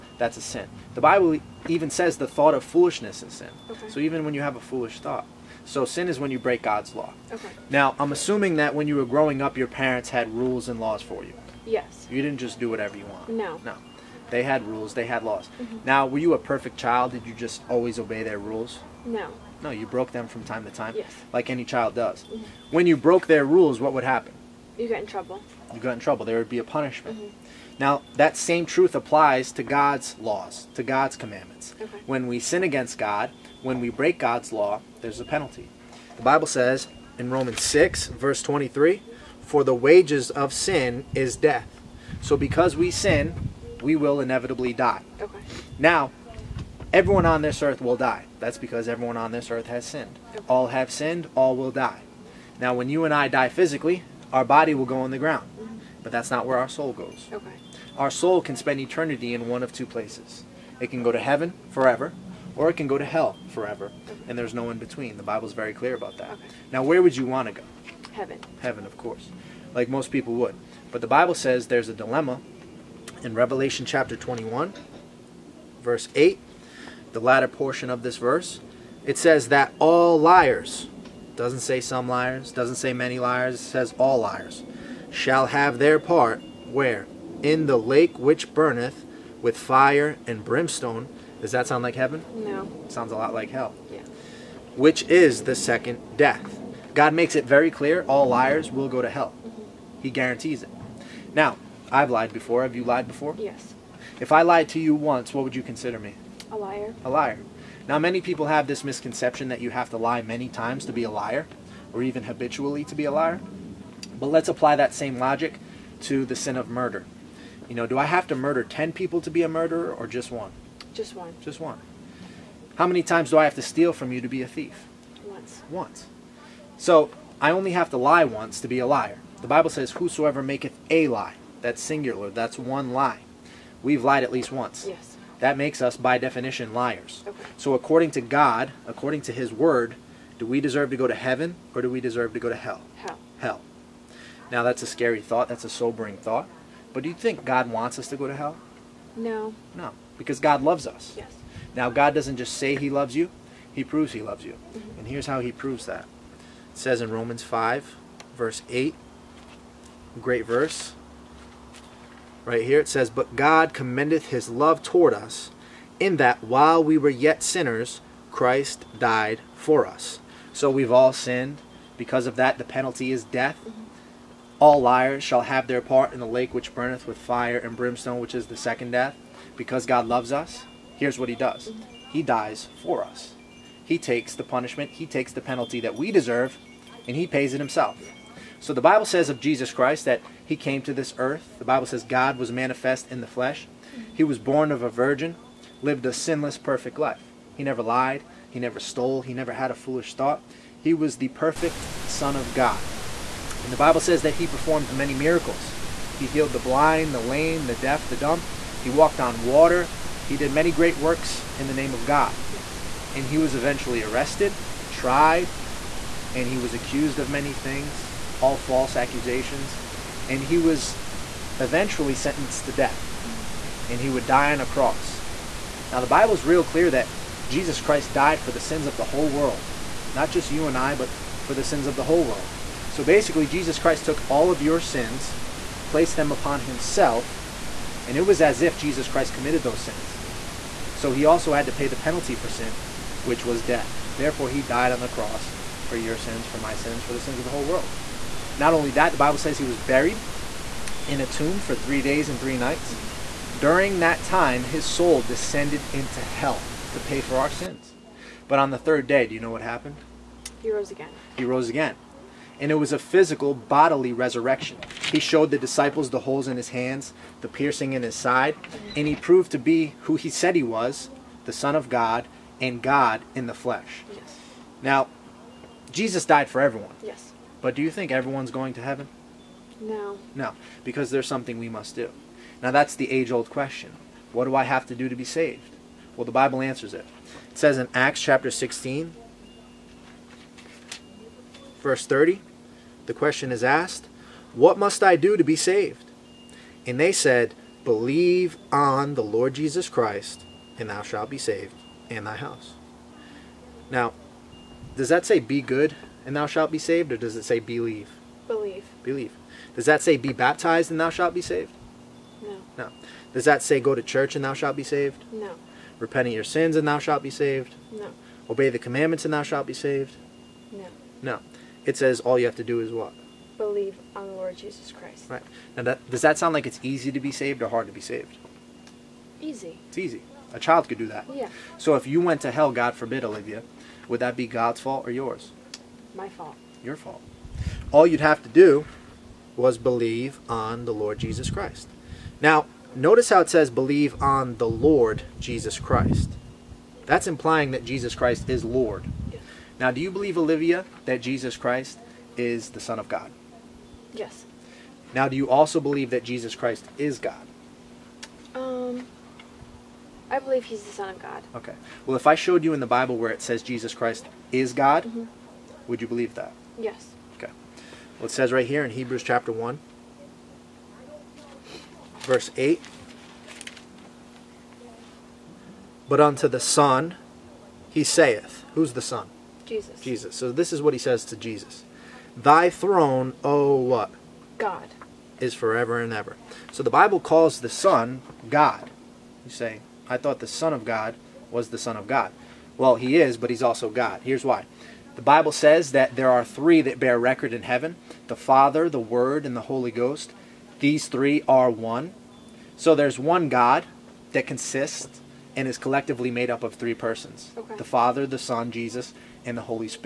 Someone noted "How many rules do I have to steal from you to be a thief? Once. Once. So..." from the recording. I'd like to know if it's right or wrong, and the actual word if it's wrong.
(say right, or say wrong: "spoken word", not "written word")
wrong: "times", not "rules".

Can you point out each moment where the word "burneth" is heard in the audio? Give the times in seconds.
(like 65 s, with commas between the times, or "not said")
88 s, 176 s.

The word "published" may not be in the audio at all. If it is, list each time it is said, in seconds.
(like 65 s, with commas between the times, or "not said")
not said.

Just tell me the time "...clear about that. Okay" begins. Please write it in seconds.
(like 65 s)
65 s.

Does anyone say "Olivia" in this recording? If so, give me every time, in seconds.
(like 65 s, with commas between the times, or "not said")
333 s, 350 s.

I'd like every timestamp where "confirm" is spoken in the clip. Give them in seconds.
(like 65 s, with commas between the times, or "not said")
not said.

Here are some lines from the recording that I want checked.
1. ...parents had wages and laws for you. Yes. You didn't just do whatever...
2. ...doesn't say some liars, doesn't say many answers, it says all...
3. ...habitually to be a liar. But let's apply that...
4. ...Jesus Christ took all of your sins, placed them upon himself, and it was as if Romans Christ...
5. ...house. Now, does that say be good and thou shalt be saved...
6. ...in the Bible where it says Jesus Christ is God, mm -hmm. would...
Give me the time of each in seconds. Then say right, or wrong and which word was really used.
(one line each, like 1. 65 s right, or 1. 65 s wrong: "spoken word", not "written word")
1. 9 s wrong: "rules", not "wages"
2. 81 s wrong: "liars", not "answers"
3. 112 s right
4. 233 s wrong: "Jesus", not "Romans"
5. 302 s right
6. 362 s right.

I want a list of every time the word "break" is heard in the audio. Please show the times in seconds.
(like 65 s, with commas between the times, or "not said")
6 s, 33 s.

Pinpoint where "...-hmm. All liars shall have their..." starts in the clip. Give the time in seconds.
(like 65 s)
173 s.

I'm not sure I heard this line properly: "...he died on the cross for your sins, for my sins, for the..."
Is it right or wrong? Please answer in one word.
right.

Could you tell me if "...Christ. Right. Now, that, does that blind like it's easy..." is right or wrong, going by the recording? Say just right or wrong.
wrong.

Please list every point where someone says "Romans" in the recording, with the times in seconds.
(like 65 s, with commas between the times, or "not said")
37 s, 157 s.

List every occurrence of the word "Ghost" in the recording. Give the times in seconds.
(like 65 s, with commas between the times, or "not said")
399 s.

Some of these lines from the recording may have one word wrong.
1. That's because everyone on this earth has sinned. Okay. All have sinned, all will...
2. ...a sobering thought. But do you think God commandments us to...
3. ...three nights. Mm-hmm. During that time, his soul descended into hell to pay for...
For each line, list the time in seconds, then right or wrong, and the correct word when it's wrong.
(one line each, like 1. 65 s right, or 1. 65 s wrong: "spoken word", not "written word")
1. 48 s right
2. 145 s wrong: "wants", not "commandments"
3. 252 s right.